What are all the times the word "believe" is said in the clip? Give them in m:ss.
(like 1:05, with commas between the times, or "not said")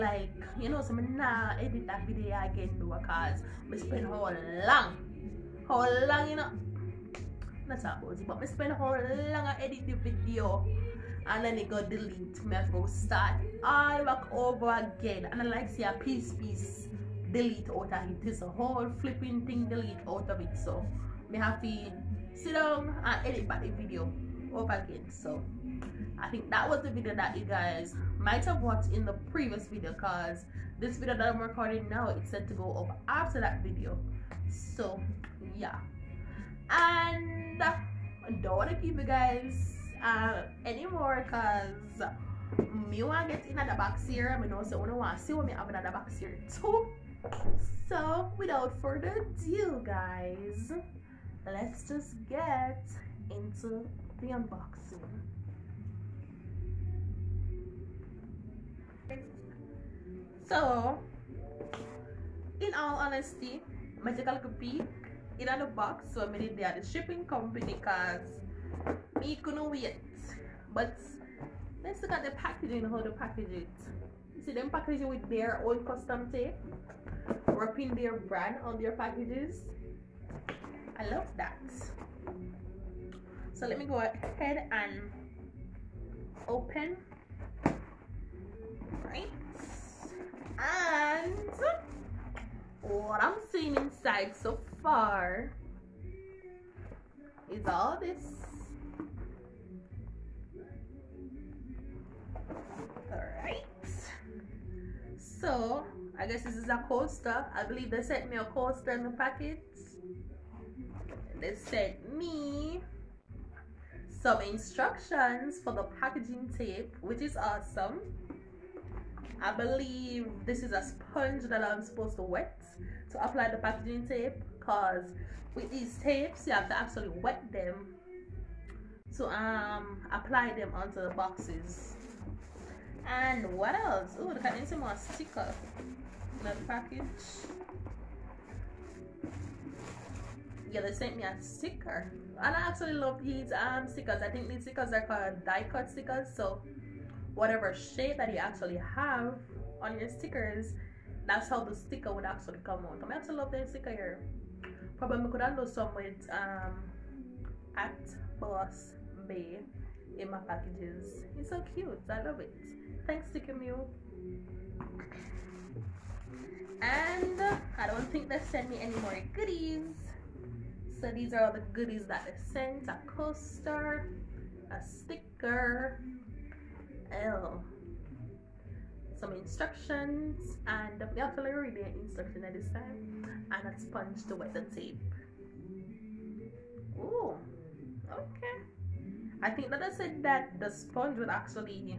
1:47, 1:59.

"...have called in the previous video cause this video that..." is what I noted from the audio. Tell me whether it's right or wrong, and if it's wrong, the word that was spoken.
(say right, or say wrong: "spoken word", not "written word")
wrong: "watched", not "called".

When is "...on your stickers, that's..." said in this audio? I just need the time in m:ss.
2:29.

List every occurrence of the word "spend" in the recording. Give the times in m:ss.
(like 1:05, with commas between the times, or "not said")
0:03, 0:08.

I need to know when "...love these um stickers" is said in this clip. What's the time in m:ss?
2:22.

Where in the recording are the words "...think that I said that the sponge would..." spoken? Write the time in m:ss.
3:09.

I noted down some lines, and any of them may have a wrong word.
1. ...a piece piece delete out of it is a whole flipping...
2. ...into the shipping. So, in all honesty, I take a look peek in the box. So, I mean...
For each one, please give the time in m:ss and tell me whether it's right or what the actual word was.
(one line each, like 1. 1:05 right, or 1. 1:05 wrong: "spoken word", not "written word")
1. 0:15 right
2. 0:53 wrong: "unboxing", not "shipping".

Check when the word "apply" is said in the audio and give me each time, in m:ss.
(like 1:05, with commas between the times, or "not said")
2:03, 2:10.